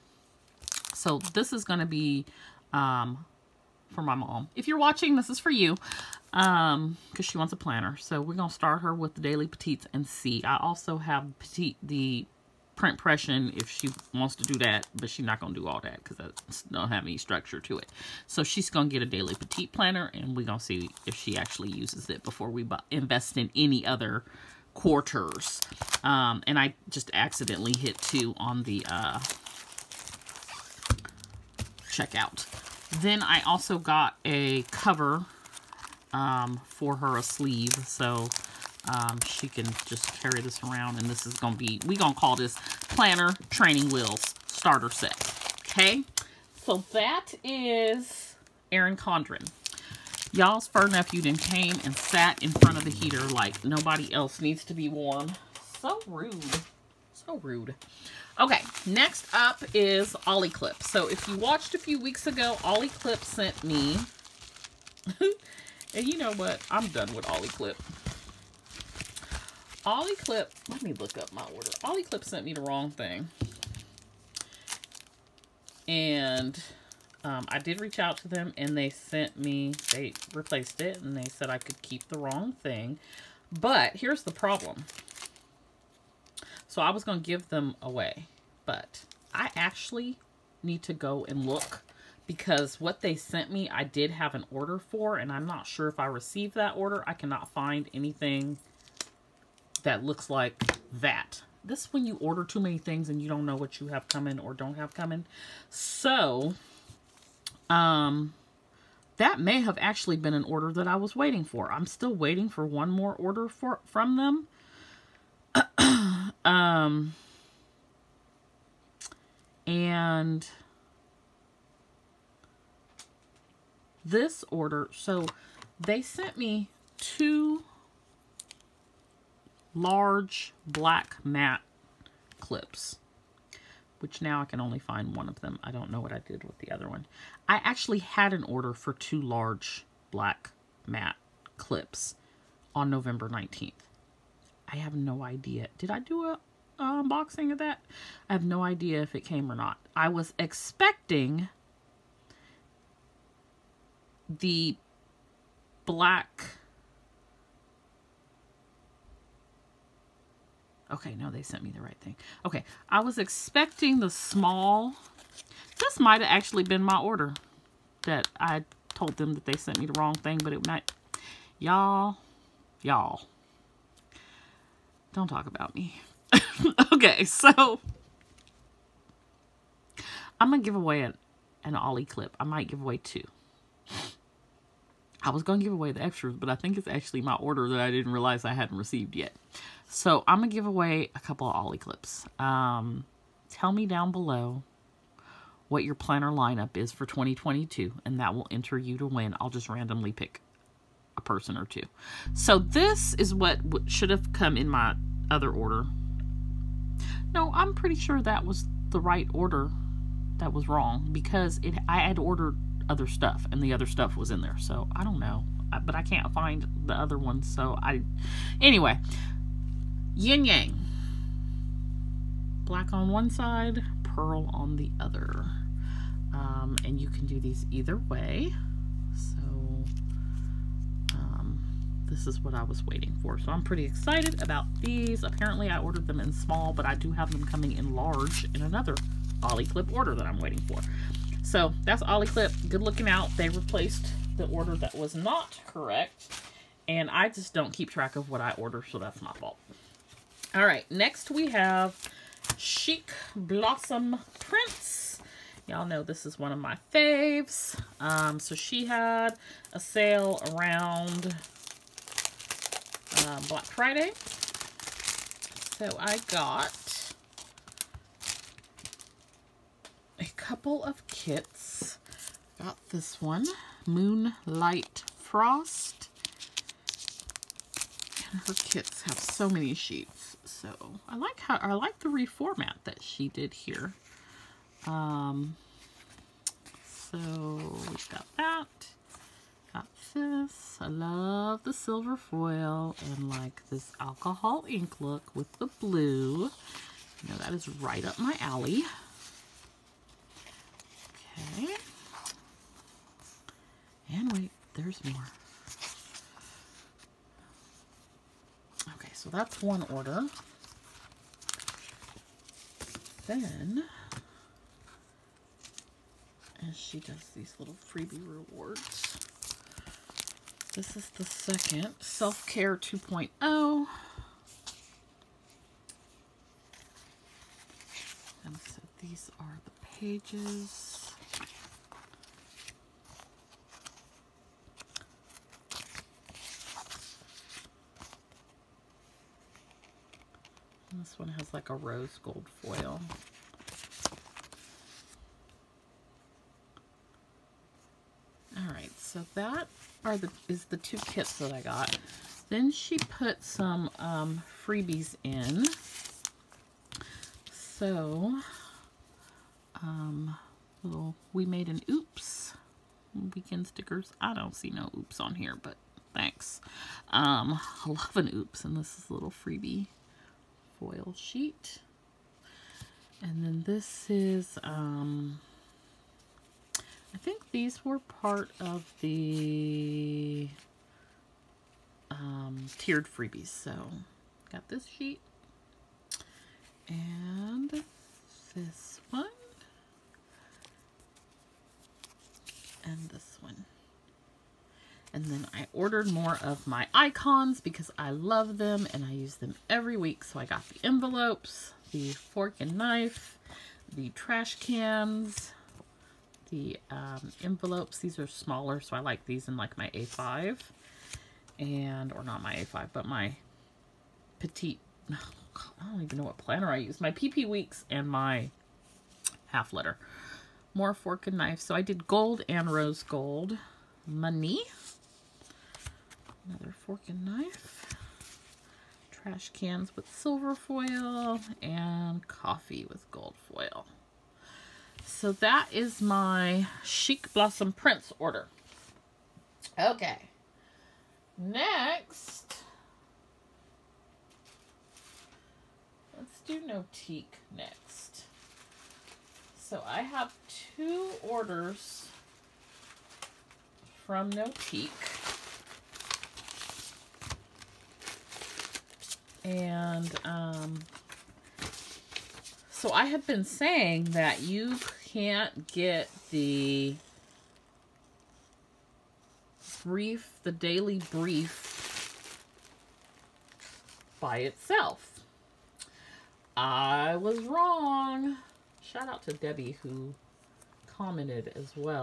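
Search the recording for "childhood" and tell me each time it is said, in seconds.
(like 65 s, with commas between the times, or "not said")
not said.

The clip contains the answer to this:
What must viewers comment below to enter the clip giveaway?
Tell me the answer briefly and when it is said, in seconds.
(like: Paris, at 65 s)
their 2022 planner lineup, at 195 s.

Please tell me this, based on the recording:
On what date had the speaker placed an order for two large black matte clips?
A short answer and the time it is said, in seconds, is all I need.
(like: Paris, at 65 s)
November 19th, at 142 s.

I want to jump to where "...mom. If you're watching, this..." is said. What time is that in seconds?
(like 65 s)
4 s.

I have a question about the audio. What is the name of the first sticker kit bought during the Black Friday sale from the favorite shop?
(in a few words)
Moonlight Frost.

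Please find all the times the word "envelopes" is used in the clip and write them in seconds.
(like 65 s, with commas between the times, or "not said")
400 s, 407 s.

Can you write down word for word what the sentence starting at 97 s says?
I cannot find anything that looks like that.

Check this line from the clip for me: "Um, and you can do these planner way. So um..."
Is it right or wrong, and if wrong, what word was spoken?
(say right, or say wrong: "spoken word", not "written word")
wrong: "either", not "planner".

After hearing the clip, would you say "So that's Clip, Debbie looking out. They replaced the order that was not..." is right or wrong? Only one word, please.
wrong.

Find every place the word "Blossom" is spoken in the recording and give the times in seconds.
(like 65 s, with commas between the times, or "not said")
253 s, 437 s.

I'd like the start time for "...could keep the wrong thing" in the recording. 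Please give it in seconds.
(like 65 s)
81 s.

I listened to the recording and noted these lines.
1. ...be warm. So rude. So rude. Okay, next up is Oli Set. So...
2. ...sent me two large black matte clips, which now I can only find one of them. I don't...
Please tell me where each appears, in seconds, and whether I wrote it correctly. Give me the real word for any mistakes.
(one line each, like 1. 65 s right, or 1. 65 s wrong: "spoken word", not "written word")
1. 54 s wrong: "Clip", not "Set"
2. 126 s right.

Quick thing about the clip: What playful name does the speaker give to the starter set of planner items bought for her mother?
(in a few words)
Planner Training Wheels Starter Set.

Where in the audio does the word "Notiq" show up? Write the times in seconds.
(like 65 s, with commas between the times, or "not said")
446 s, 454 s.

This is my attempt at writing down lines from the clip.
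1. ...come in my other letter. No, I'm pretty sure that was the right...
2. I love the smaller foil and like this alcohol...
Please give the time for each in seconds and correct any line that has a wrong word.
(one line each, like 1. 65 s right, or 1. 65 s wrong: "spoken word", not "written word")
1. 204 s wrong: "order", not "letter"
2. 290 s wrong: "silver", not "smaller".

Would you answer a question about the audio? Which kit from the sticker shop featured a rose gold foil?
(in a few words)
Self Care 2.0.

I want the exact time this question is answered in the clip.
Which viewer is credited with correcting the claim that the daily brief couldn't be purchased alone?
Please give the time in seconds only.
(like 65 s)
479 s.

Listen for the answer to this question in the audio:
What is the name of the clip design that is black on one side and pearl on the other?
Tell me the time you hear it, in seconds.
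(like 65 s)
220 s.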